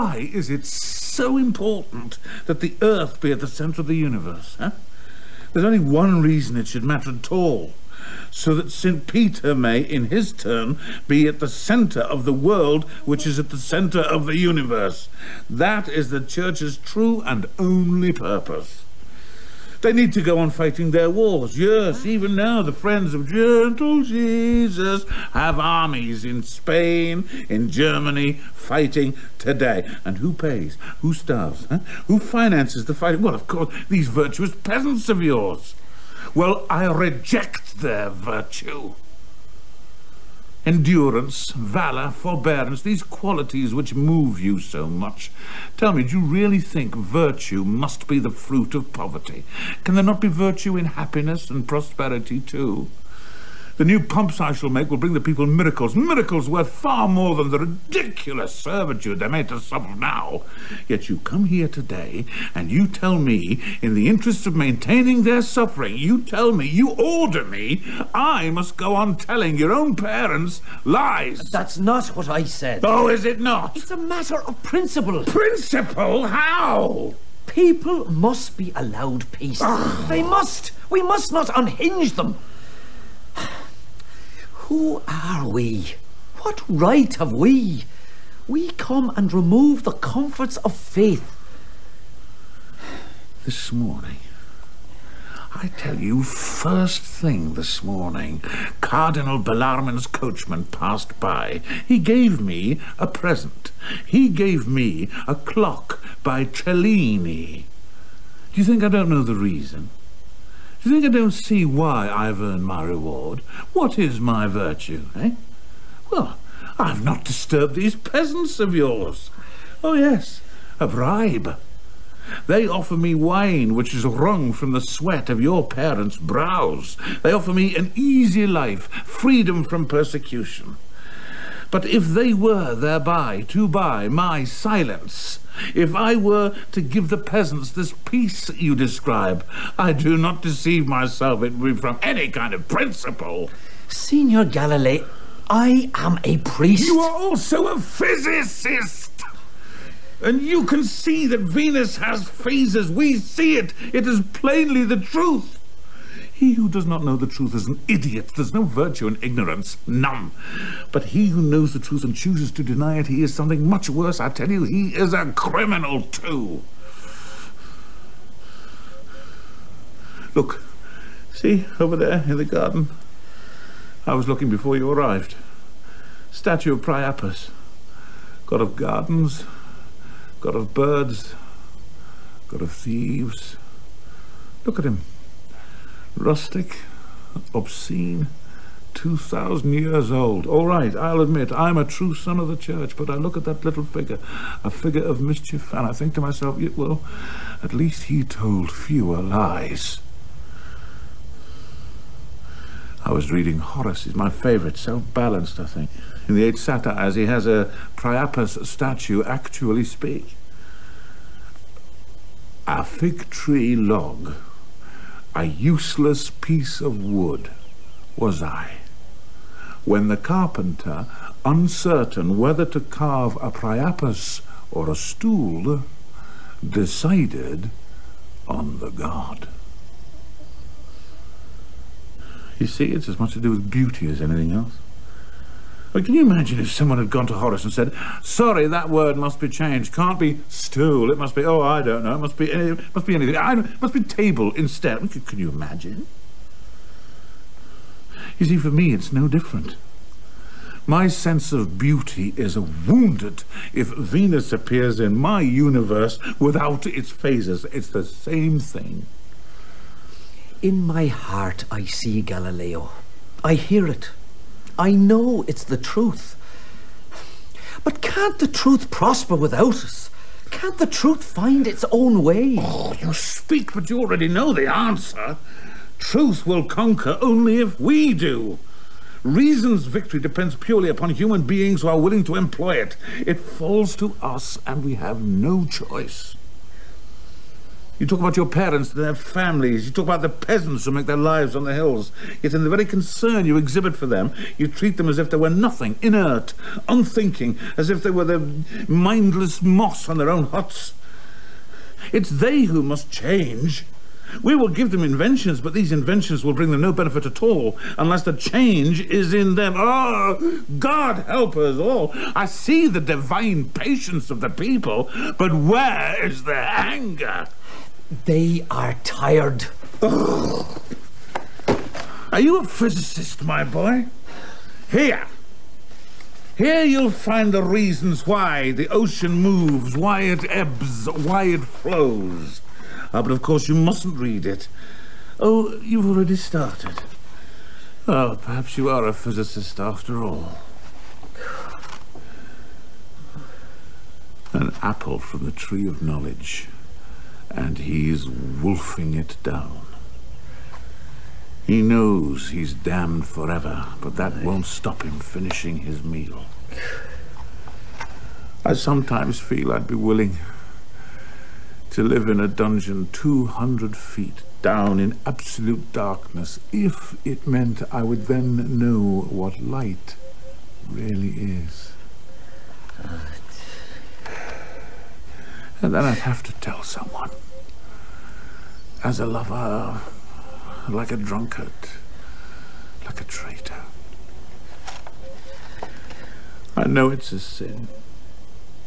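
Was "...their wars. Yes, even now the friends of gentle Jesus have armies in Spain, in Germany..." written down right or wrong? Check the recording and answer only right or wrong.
right.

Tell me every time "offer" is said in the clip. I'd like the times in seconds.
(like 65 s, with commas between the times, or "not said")
122 s, 127 s.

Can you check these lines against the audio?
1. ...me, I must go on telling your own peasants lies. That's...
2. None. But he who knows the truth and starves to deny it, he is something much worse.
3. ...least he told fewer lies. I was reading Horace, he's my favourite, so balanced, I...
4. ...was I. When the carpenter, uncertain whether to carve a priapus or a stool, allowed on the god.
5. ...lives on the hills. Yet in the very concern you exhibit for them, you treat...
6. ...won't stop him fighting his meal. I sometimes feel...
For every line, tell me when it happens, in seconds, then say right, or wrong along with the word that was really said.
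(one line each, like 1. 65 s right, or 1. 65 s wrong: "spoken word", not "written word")
1. 67 s wrong: "parents", not "peasants"
2. 159 s wrong: "chooses", not "starves"
3. 197 s right
4. 218 s wrong: "decided", not "allowed"
5. 291 s right
6. 354 s wrong: "finishing", not "fighting".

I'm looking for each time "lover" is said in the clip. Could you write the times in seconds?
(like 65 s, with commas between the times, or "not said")
379 s.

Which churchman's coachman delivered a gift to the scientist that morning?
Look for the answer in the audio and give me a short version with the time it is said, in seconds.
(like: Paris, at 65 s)
Cardinal Bellarmine, at 98 s.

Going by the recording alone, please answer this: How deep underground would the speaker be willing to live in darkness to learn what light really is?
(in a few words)
200 feet.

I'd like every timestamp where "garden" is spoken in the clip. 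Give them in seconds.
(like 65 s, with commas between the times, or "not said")
172 s, 178 s.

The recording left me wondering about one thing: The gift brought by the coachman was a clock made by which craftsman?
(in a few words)
Cellini.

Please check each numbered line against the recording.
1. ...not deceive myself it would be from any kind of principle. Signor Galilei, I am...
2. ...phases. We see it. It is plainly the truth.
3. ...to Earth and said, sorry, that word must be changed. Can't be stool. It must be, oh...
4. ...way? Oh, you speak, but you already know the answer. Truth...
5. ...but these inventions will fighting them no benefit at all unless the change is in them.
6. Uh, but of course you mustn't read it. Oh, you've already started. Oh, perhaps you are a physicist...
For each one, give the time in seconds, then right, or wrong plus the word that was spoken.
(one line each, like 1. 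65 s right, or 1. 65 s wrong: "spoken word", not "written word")
1. 140 s right
2. 152 s right
3. 237 s wrong: "Horace", not "Earth"
4. 272 s right
5. 305 s wrong: "bring", not "fighting"
6. 333 s right.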